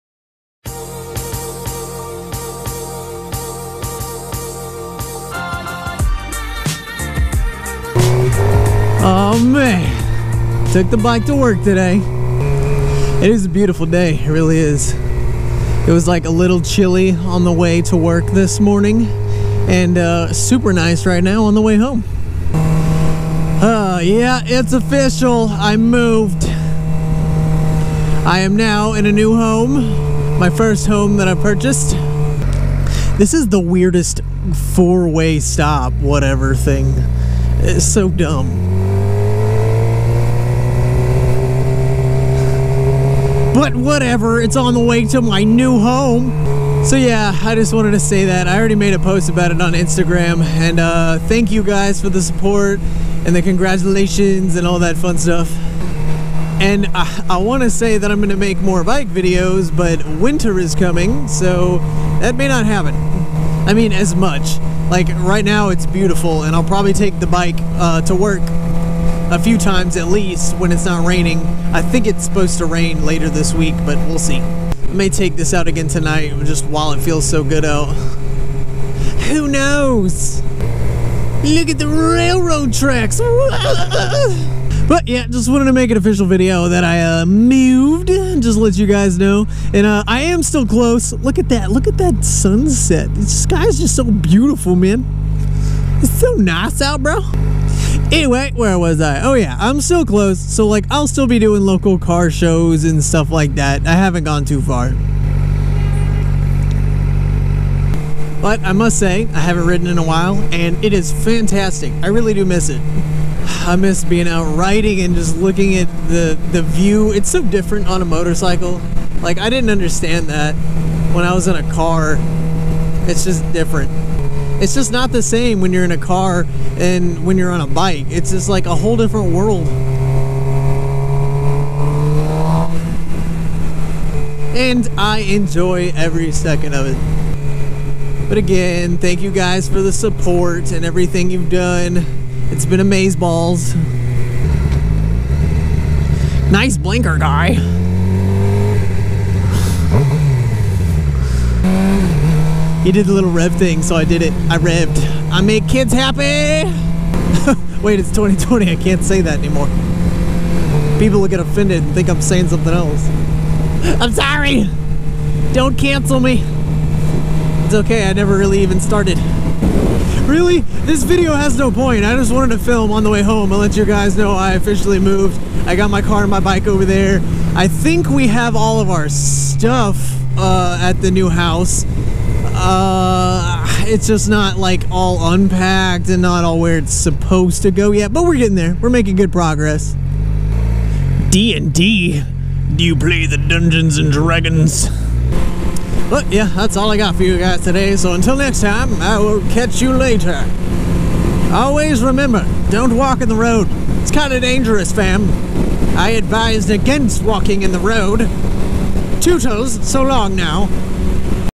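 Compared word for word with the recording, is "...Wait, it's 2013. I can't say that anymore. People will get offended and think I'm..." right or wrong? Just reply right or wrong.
wrong.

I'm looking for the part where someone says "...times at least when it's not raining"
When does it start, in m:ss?
1:09.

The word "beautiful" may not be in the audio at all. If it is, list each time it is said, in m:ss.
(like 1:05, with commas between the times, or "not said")
0:13, 1:05, 1:34.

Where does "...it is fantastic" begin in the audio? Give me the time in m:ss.
1:50.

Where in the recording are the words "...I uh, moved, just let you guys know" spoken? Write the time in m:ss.
1:26.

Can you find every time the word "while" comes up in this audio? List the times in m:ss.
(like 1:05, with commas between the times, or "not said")
1:16, 1:50.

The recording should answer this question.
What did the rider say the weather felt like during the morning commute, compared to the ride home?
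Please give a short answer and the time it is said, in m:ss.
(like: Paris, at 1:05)
Chilly, at 0:16.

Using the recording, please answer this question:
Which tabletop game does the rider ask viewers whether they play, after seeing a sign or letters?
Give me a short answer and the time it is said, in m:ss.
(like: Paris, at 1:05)
Dungeons and Dragons, at 3:13.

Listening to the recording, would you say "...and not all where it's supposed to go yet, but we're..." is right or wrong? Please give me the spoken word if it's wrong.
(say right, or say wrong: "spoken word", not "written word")
right.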